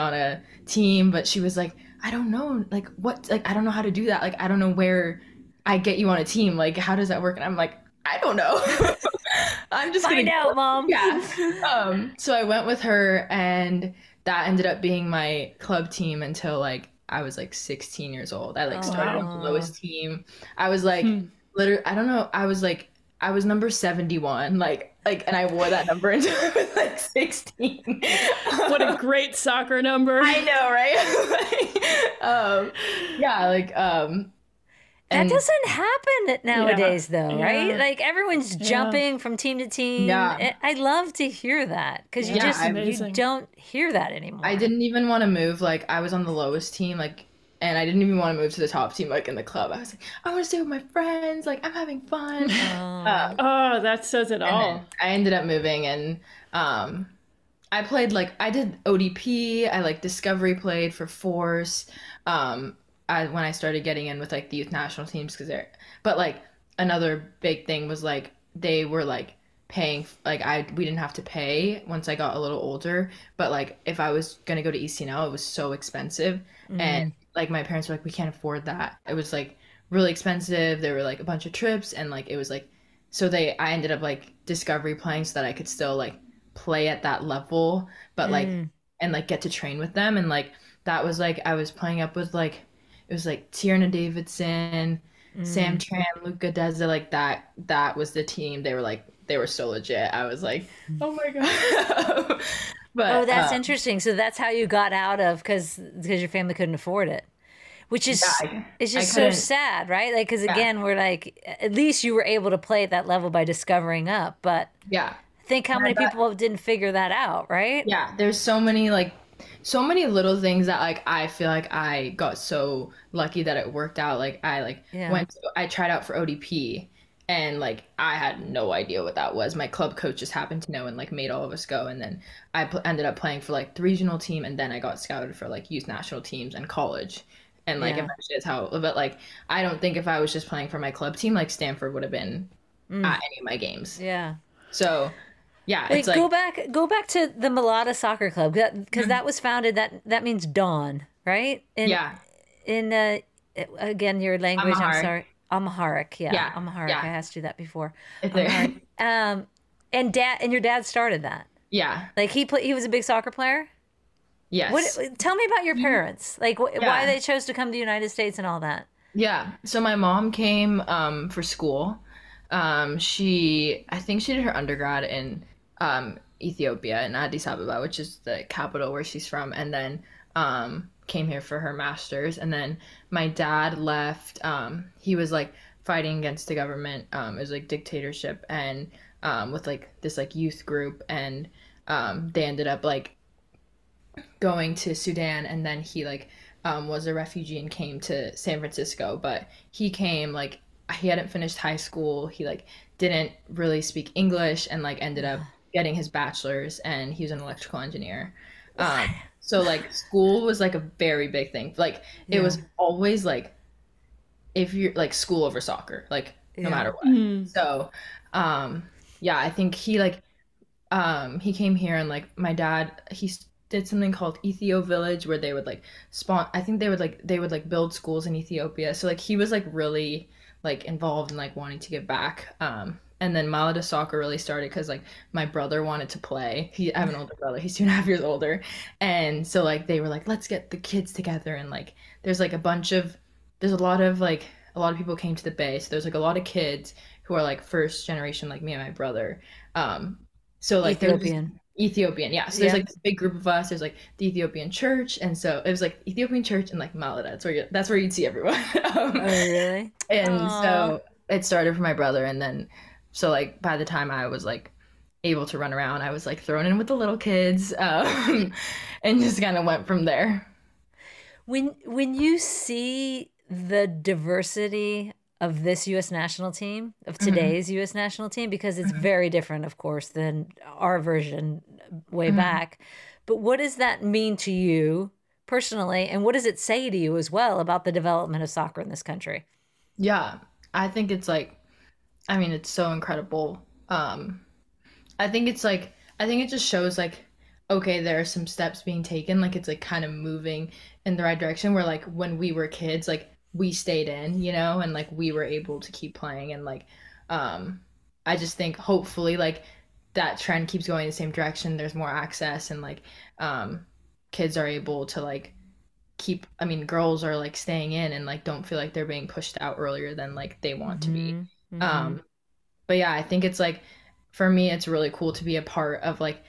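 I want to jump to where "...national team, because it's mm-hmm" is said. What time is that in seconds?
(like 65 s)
277 s.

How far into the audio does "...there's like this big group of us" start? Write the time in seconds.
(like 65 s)
252 s.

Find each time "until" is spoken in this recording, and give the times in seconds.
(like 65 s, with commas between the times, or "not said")
16 s, 26 s.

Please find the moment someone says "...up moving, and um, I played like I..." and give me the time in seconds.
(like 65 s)
55 s.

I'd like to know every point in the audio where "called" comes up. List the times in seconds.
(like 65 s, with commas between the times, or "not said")
224 s.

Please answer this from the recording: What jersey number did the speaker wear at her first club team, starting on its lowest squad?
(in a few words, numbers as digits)
71.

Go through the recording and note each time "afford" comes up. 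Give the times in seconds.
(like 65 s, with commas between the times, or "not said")
78 s, 106 s.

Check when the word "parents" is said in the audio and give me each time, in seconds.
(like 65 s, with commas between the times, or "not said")
77 s, 165 s.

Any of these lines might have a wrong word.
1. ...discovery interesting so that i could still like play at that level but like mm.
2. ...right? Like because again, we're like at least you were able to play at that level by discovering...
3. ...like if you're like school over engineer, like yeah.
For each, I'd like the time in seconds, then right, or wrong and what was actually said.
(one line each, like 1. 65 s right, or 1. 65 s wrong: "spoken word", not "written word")
1. 84 s wrong: "playing", not "interesting"
2. 109 s right
3. 213 s wrong: "soccer", not "engineer".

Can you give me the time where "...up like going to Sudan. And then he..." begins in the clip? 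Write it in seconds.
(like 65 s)
192 s.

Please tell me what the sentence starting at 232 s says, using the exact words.
Um and then Maleda soccer really started because like my brother wanted to play.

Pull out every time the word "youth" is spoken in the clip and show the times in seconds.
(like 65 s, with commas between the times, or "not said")
64 s, 135 s, 190 s.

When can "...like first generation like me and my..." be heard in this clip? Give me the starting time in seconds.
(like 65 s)
247 s.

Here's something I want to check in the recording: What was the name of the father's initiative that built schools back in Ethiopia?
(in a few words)
Ethio Village.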